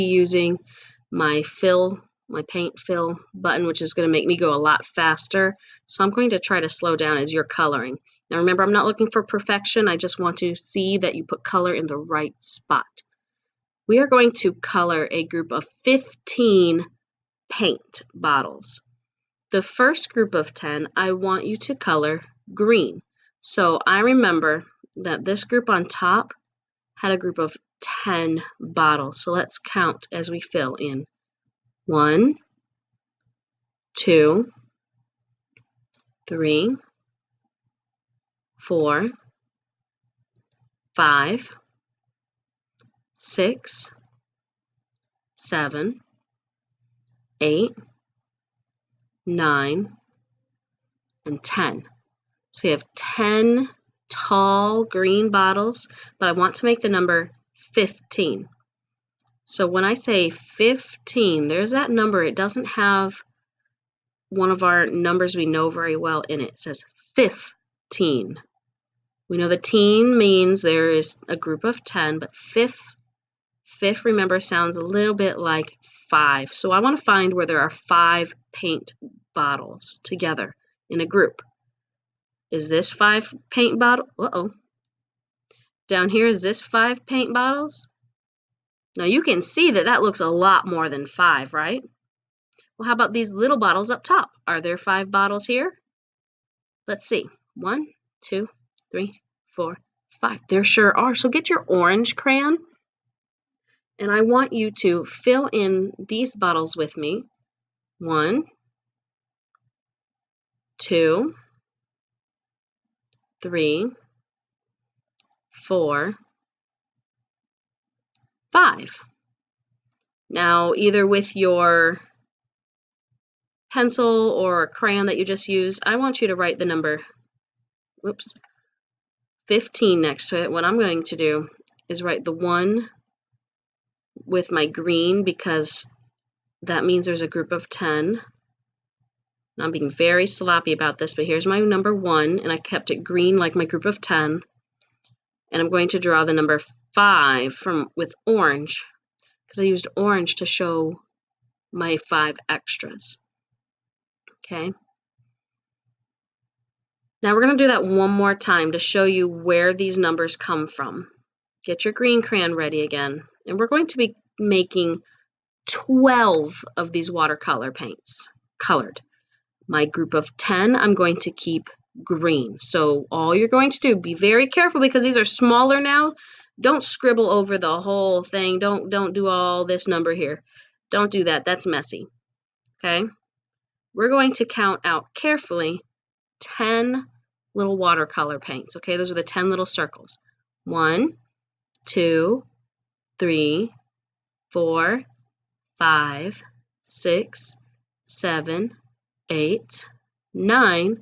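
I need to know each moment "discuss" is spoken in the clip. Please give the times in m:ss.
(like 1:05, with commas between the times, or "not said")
not said.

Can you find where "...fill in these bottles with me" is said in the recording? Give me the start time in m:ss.
1:45.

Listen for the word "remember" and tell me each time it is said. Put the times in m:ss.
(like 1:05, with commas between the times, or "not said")
0:08, 0:24, 1:14.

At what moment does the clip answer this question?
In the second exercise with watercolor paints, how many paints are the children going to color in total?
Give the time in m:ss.
2:45.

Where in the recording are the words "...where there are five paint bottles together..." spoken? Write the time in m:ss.
1:17.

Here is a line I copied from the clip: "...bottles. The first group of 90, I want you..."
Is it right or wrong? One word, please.
wrong.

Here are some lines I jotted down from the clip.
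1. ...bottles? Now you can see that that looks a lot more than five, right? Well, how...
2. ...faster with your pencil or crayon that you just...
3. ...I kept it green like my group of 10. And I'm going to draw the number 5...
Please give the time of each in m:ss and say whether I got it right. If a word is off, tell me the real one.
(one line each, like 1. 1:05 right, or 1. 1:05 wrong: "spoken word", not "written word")
1. 1:27 right
2. 2:00 wrong: "either", not "faster"
3. 2:22 right.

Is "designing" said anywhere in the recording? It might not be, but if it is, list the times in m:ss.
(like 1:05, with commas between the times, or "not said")
not said.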